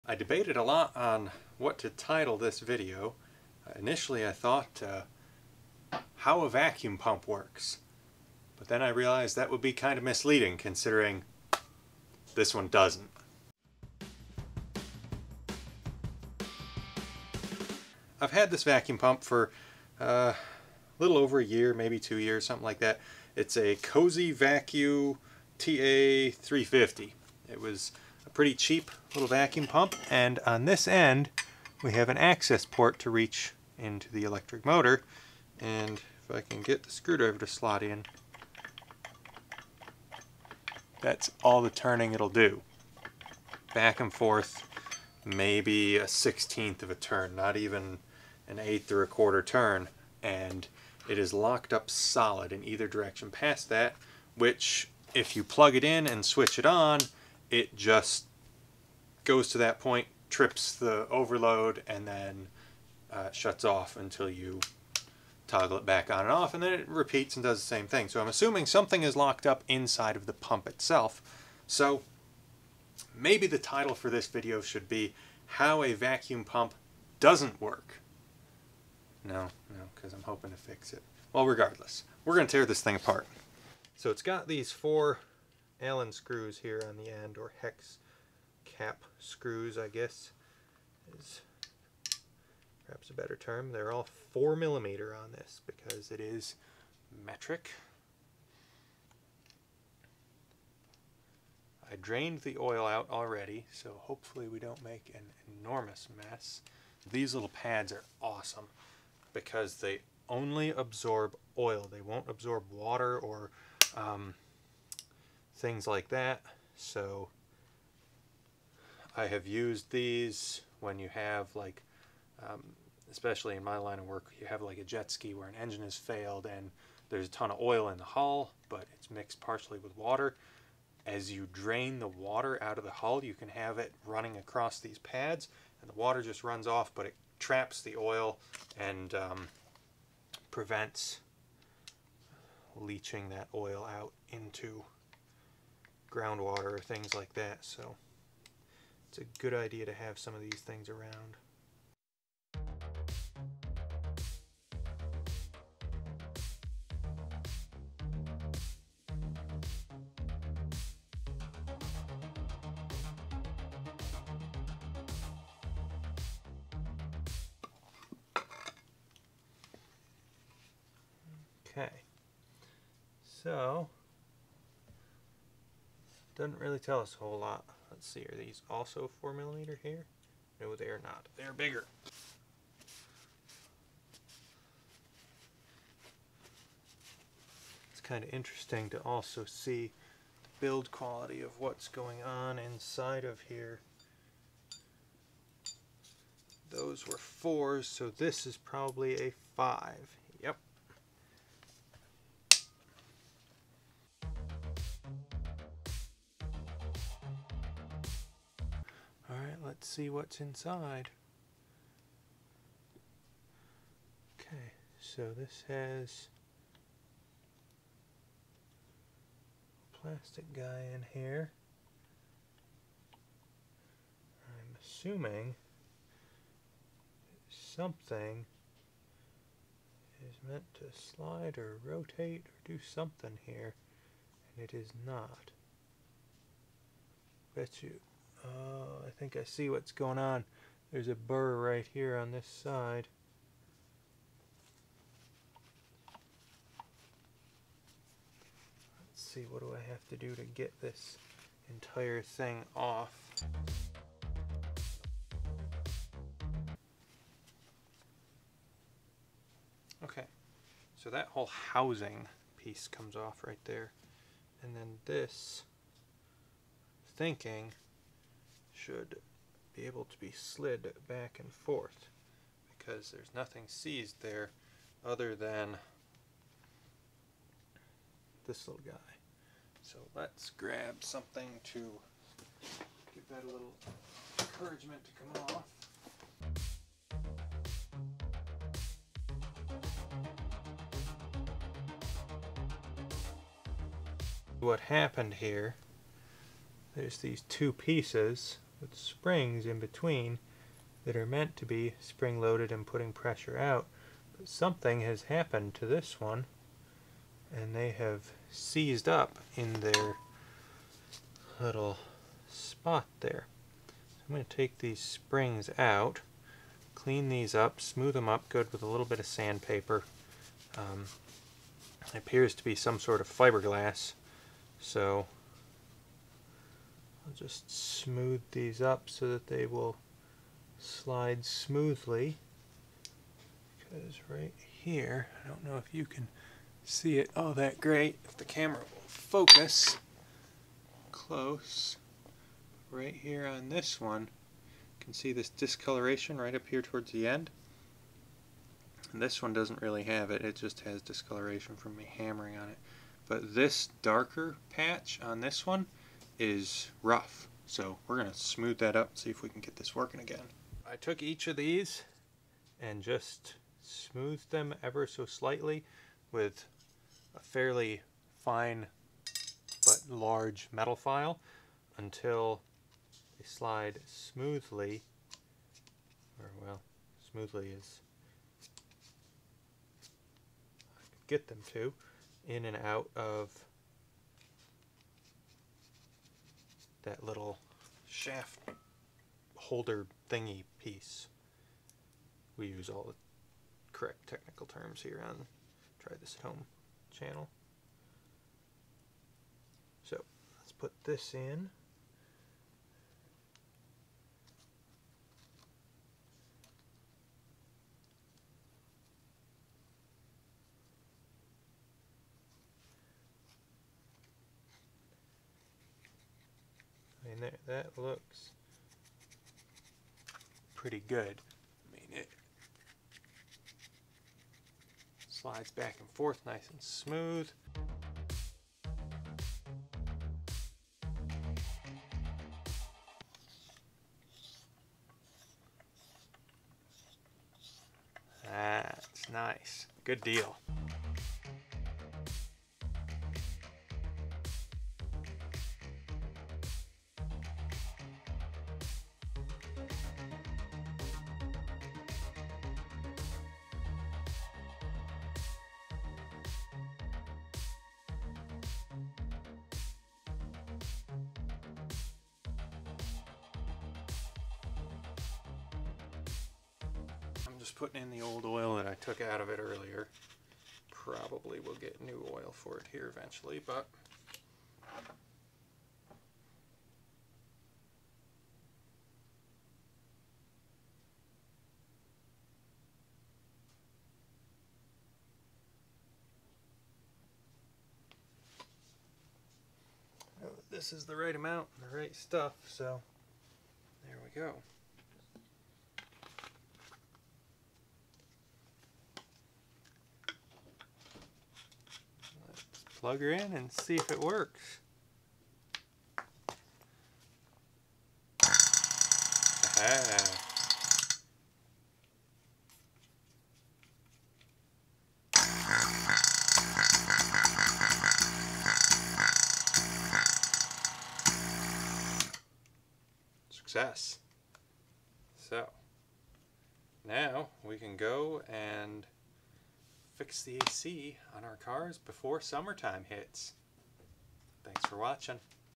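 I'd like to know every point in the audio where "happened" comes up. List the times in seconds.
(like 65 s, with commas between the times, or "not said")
294 s, 305 s.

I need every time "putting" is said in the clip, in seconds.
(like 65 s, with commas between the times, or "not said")
302 s, 467 s.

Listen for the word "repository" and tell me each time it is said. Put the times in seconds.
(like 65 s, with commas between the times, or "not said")
not said.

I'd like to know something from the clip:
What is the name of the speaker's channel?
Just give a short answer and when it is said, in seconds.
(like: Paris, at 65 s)
Try This at Home, at 395 s.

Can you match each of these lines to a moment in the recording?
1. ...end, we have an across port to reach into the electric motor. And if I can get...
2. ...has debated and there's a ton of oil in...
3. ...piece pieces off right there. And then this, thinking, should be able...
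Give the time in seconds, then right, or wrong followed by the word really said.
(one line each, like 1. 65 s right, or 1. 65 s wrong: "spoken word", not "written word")
1. 30 s wrong: "access", not "across"
2. 125 s wrong: "failed", not "debated"
3. 262 s wrong: "comes", not "pieces".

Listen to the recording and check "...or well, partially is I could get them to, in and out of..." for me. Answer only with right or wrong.
wrong.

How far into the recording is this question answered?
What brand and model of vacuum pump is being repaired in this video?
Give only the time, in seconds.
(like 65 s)
23 s.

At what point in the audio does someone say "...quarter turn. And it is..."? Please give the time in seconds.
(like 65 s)
49 s.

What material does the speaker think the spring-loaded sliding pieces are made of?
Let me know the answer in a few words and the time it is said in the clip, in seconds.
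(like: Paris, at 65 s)
fiberglass, at 323 s.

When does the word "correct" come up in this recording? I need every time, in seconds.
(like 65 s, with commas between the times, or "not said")
393 s.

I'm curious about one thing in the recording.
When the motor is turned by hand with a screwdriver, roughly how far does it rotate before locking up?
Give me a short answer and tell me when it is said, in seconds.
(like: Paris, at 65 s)
a sixteenth of a turn, at 45 s.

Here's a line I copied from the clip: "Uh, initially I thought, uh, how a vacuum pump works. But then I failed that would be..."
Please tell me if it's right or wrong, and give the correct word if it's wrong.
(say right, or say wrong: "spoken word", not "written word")
wrong: "realized", not "failed".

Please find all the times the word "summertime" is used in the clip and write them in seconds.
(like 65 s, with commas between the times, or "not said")
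532 s.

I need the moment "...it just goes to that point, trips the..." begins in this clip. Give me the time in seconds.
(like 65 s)
57 s.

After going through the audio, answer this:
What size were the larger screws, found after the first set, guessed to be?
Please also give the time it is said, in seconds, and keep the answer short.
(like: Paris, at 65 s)
5, at 199 s.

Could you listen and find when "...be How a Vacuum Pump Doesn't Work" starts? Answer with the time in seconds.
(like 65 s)
74 s.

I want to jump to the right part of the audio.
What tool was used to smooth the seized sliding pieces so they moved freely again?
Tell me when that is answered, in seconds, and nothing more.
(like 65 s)
370 s.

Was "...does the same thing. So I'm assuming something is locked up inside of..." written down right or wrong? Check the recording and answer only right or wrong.
right.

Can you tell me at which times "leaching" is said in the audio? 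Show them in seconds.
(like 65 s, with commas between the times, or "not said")
142 s.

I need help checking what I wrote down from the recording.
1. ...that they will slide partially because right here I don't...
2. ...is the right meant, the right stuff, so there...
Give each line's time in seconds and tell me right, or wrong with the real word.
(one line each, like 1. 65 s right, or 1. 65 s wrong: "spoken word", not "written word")
1. 329 s wrong: "smoothly", not "partially"
2. 490 s wrong: "amount", not "meant".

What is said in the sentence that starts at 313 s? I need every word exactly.
So I'm going to take these springs out, clean these up, smooth them up good with a little bit of sandpaper.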